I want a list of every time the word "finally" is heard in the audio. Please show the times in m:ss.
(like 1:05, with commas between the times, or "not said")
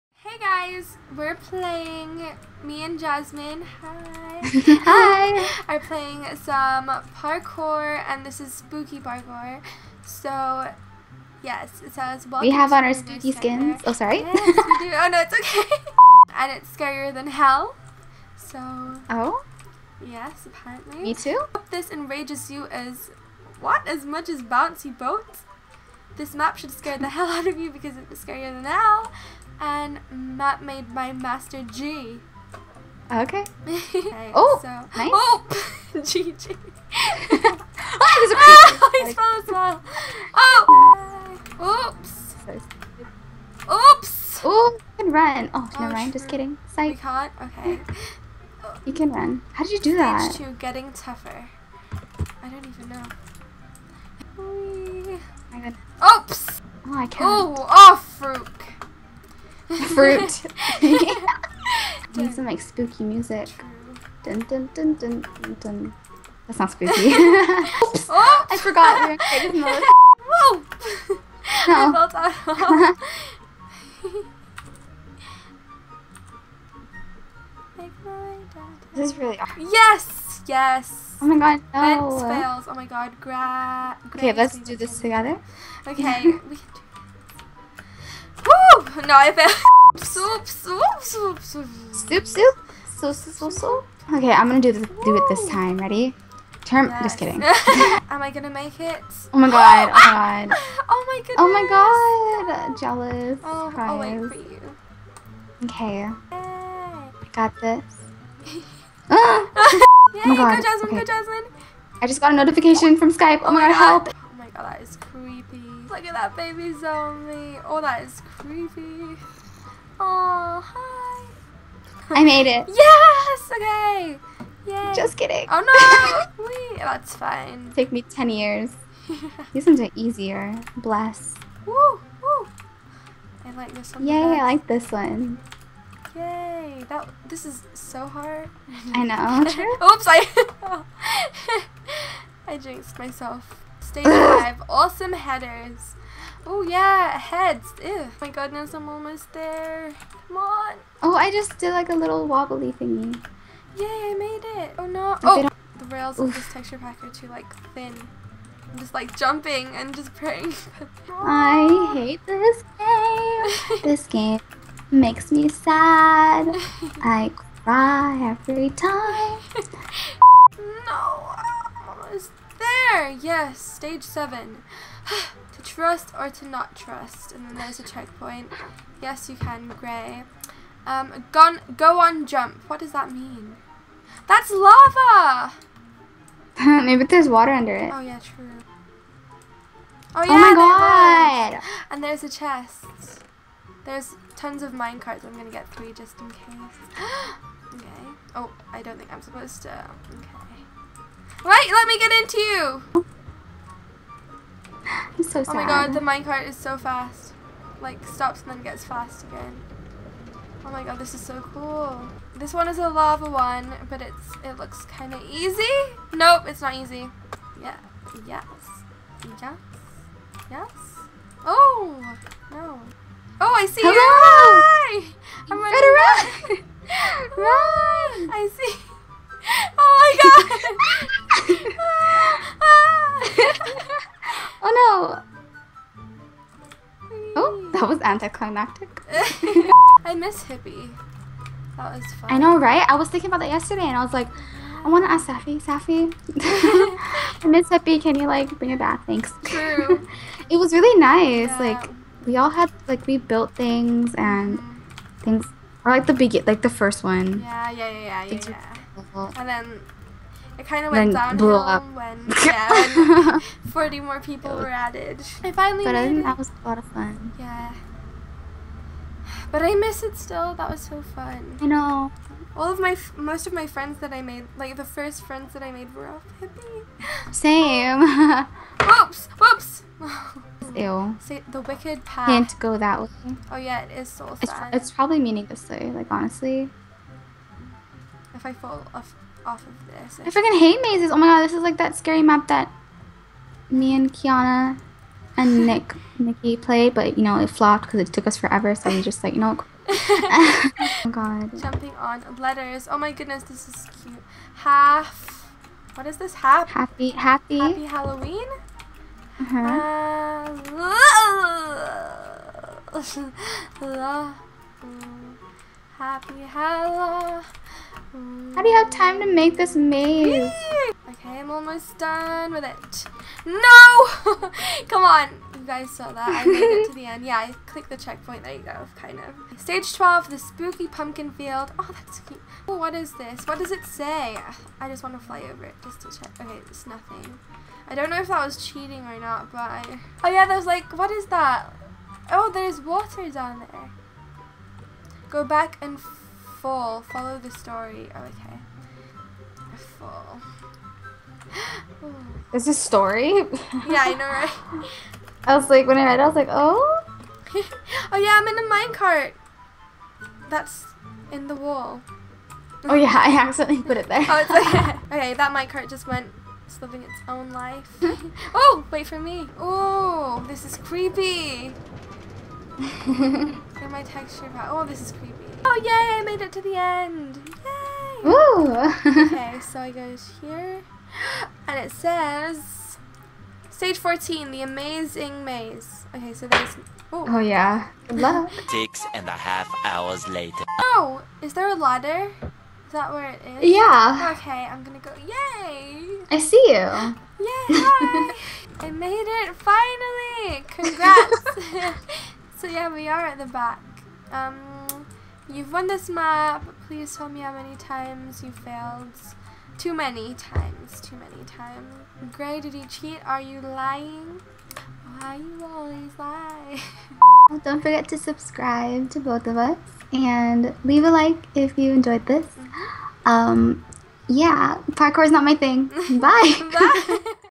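4:25, 6:39.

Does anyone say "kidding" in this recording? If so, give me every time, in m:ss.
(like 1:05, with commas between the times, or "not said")
0:46, 1:37, 2:05.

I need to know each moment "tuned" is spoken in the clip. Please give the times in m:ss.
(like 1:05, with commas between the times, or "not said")
not said.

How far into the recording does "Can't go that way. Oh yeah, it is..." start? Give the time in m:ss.
4:42.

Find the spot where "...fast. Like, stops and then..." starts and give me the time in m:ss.
3:26.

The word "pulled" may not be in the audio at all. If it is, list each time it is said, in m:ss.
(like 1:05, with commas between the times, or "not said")
not said.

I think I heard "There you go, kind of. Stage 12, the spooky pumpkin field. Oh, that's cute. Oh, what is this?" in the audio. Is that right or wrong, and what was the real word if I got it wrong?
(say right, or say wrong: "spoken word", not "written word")
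right.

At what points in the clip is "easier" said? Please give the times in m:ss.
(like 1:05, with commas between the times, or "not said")
2:09.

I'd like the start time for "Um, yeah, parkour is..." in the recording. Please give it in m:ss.
7:03.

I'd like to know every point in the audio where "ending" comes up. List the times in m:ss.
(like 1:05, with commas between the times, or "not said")
not said.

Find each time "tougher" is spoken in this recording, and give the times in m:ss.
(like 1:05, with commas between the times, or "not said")
0:50.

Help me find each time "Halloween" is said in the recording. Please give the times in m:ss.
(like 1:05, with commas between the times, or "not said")
5:07, 5:16.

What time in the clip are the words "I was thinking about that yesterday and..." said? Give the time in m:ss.
4:02.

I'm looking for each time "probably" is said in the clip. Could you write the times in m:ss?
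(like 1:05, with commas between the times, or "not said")
4:44.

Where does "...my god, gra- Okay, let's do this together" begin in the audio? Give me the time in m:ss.
1:22.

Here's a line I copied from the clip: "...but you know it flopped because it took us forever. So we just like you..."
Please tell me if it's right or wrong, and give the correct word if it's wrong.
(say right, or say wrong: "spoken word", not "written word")
right.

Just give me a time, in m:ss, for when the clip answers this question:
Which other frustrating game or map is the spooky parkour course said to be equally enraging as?
0:24.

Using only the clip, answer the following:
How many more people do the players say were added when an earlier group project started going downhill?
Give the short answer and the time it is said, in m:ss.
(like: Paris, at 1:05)
40, at 4:23.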